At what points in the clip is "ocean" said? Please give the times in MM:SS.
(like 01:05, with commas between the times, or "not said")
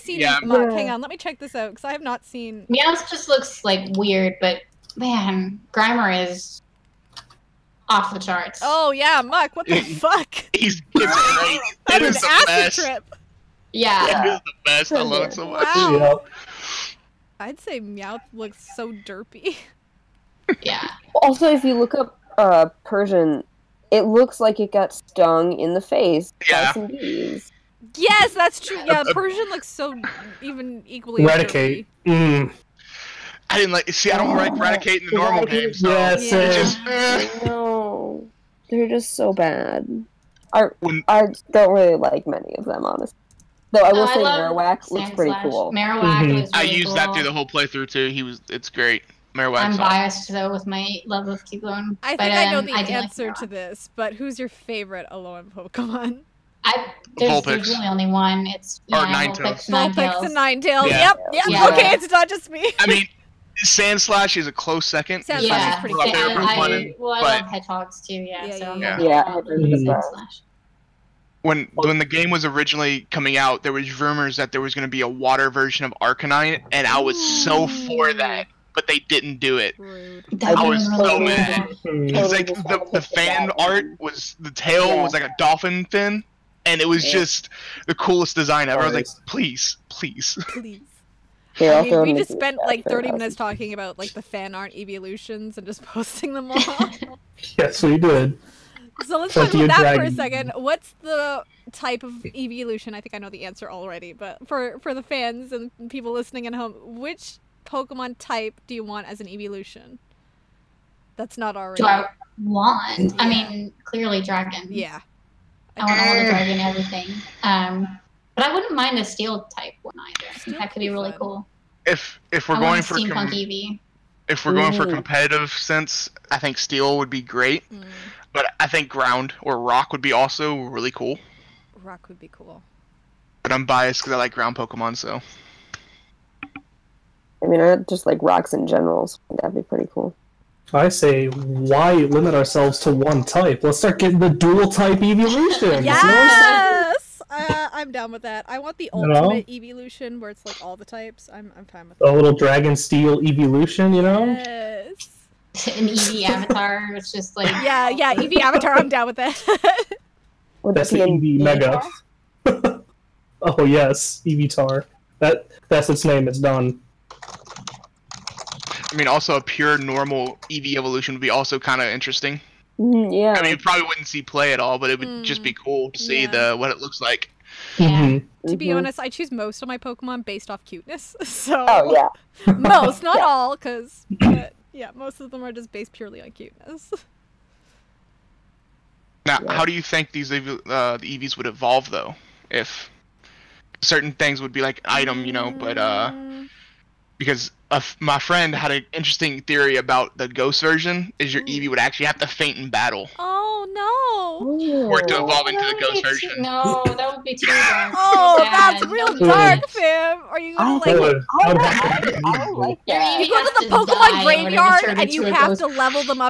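not said.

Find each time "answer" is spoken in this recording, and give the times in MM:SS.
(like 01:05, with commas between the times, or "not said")
00:52, 01:43.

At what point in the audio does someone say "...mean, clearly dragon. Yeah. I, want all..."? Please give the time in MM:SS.
01:53.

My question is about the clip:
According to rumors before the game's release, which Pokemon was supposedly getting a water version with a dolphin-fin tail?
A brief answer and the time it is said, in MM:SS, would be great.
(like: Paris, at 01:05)
Arcanine, at 01:16.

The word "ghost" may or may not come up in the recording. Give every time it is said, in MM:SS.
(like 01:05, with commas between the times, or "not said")
03:20, 03:25.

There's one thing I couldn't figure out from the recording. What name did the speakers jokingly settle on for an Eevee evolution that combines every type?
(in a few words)
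EV tar.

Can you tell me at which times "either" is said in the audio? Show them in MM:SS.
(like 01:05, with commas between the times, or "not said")
01:59.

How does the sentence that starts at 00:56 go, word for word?
I, there's, there's, really only one.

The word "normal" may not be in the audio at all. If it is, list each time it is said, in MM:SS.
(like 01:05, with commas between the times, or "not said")
00:35, 02:49.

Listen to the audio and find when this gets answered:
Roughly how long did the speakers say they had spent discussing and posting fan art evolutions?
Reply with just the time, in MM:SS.
01:32.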